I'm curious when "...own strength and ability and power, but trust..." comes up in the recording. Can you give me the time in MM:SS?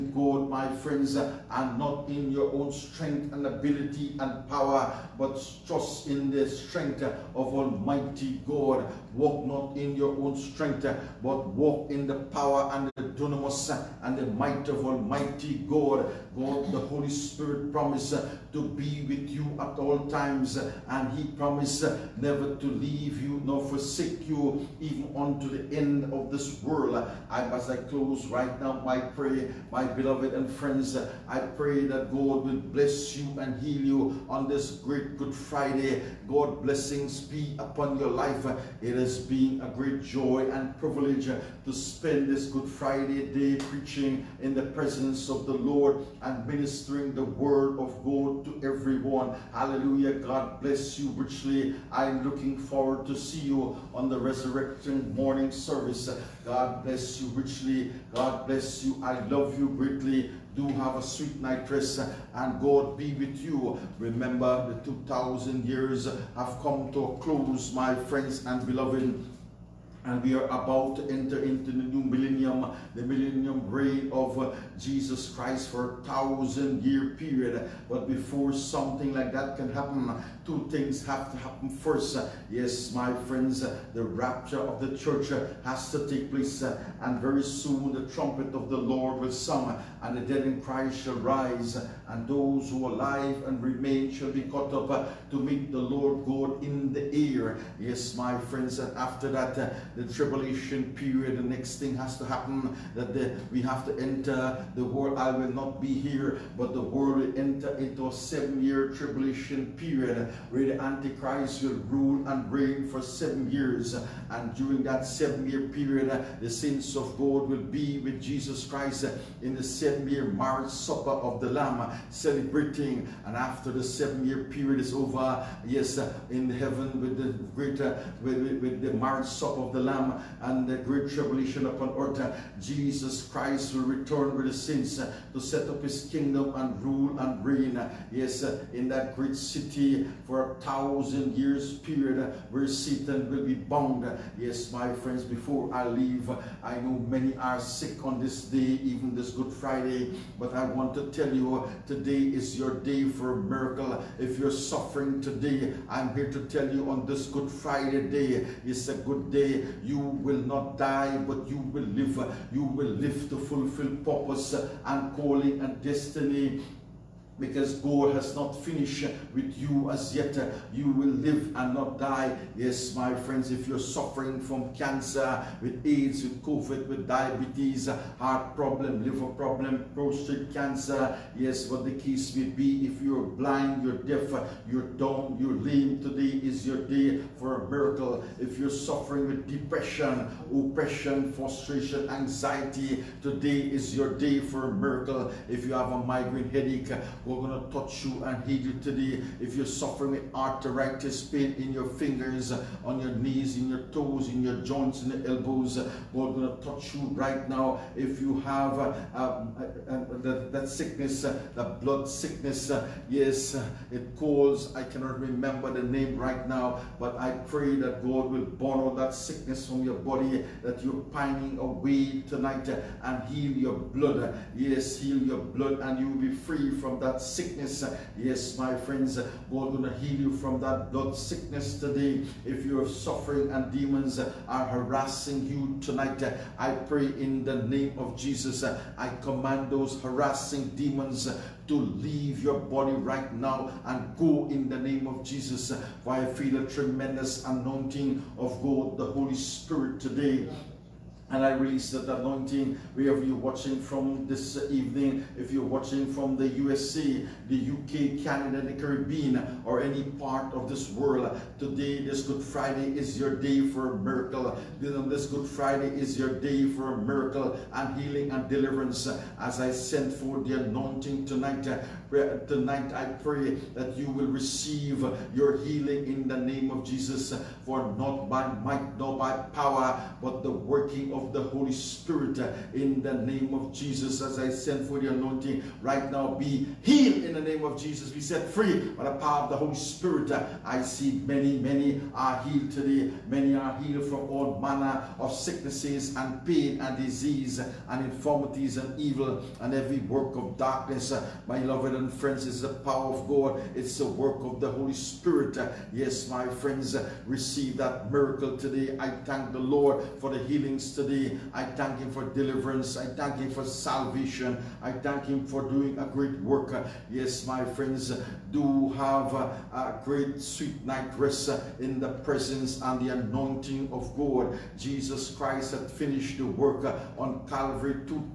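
00:02.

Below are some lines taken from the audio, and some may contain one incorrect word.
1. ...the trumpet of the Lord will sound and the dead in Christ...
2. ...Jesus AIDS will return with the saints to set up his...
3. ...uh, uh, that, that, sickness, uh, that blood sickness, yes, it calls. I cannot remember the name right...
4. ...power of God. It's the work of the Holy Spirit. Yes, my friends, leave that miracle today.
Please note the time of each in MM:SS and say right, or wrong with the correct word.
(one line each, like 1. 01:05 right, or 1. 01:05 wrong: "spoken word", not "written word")
1. 01:27 right
2. 02:12 wrong: "Christ", not "AIDS"
3. 03:29 right
4. 05:02 wrong: "receive", not "leave".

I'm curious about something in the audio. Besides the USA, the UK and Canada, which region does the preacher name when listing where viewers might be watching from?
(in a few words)
The Caribbean.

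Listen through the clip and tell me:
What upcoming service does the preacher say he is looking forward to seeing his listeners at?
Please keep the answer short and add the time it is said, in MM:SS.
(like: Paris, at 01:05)
Resurrection morning service, at 00:54.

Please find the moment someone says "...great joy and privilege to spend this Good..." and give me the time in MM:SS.
00:39.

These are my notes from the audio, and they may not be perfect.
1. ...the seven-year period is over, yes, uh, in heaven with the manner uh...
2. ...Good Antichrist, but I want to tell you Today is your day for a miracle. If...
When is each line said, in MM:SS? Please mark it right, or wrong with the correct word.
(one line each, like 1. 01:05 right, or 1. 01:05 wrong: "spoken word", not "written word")
1. 02:03 wrong: "greater", not "manner"
2. 02:29 wrong: "Friday", not "Antichrist".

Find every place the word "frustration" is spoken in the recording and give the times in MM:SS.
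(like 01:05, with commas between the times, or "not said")
03:11.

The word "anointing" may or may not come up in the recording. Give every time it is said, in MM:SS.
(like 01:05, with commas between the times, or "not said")
04:07, 04:12, 04:30, 04:45, 05:23.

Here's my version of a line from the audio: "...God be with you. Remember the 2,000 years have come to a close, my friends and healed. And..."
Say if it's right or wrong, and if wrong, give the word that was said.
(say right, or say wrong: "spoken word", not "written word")
wrong: "beloved", not "healed".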